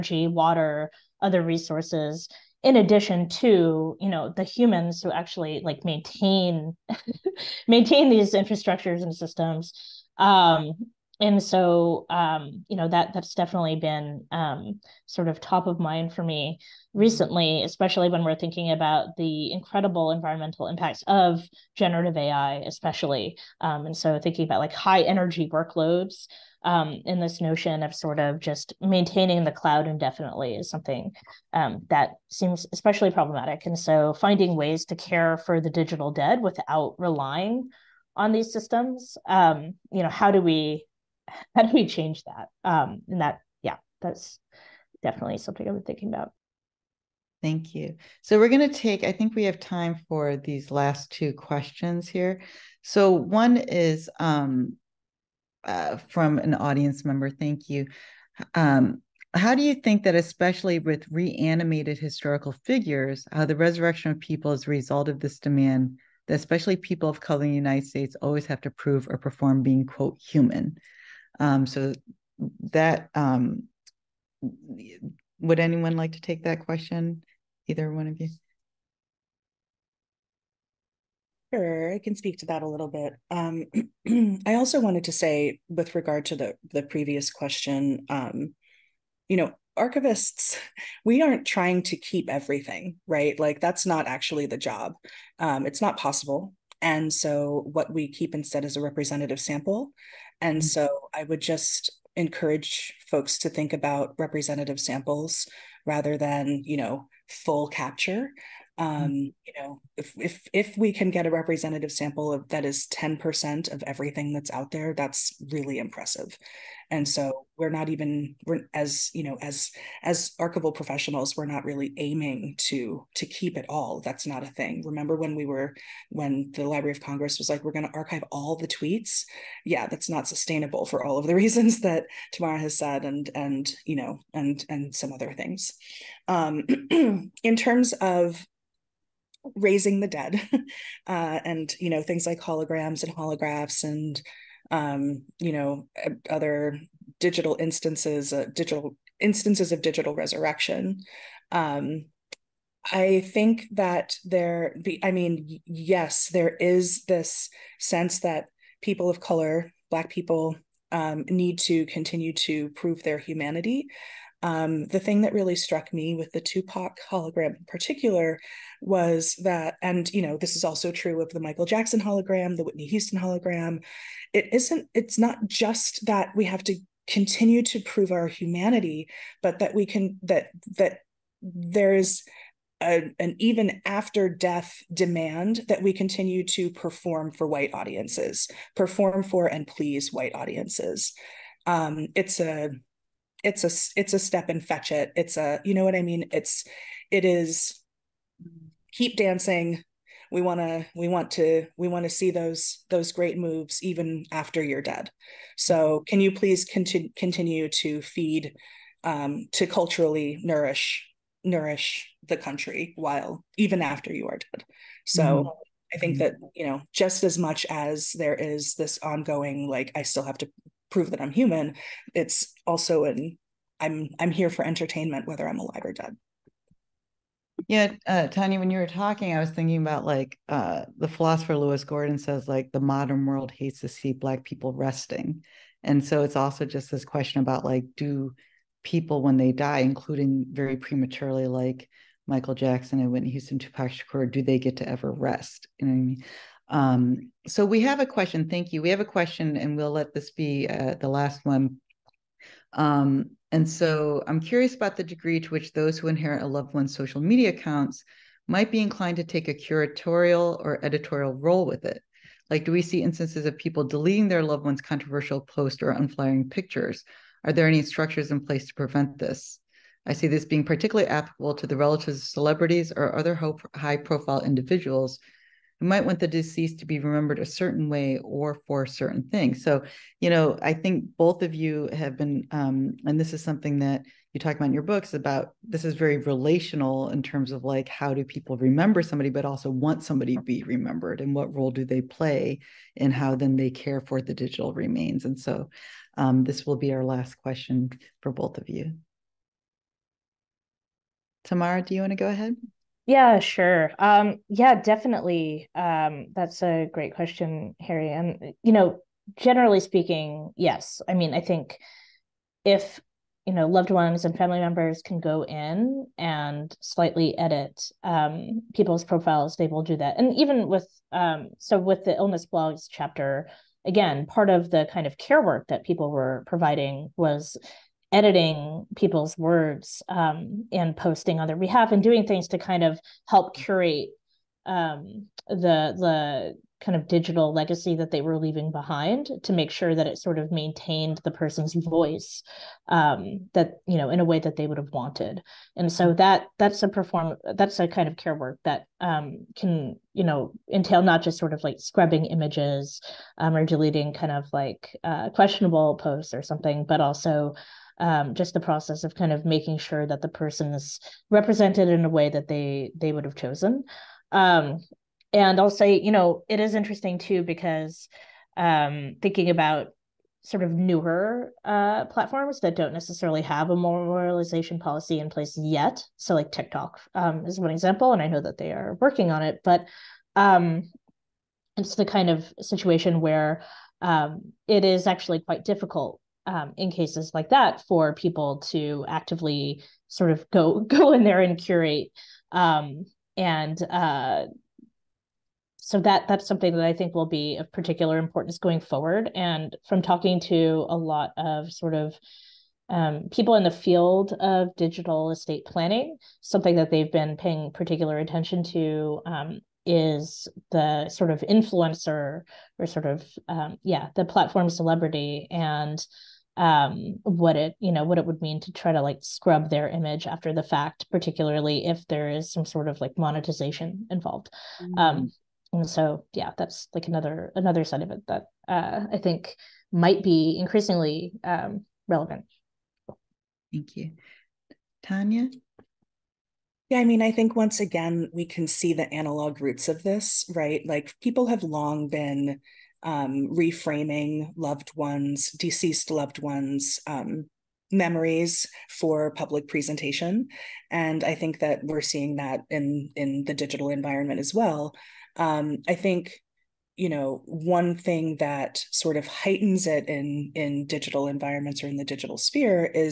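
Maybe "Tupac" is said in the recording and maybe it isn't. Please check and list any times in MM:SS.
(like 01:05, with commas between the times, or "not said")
02:46, 04:03.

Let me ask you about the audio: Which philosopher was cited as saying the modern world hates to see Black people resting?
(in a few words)
Lewis Gordon.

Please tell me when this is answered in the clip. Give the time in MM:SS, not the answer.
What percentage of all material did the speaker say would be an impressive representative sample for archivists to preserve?
01:52.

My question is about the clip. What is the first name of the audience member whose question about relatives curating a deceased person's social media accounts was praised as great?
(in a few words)
Harry.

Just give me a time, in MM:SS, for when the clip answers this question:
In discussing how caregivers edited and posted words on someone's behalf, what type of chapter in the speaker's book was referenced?
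05:22.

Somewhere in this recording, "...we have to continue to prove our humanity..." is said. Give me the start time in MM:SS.
02:56.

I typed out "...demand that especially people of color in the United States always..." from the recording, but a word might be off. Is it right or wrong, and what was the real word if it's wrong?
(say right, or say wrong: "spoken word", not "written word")
right.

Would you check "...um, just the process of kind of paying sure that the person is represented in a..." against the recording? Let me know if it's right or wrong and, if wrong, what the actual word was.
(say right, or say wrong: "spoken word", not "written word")
wrong: "making", not "paying".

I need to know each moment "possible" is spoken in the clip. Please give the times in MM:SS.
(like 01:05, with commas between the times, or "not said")
01:35.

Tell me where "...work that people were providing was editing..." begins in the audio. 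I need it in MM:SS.
05:25.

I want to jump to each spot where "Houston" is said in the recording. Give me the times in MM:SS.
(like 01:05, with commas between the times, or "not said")
02:52, 04:03.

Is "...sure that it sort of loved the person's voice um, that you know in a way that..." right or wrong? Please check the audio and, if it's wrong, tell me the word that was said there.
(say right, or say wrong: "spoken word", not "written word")
wrong: "maintained", not "loved".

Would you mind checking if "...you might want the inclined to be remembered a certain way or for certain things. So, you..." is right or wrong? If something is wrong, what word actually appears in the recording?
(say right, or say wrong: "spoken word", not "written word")
wrong: "deceased", not "inclined".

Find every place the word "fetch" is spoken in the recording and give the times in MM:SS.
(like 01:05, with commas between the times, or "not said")
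03:14.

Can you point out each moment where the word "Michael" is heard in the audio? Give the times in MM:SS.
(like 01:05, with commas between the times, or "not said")
02:51, 04:02.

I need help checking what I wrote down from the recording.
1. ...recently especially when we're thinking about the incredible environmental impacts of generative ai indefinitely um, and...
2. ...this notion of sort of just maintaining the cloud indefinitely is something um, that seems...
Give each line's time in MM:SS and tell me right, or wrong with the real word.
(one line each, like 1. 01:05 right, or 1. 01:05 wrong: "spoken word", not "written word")
1. 00:16 wrong: "especially", not "indefinitely"
2. 00:27 right.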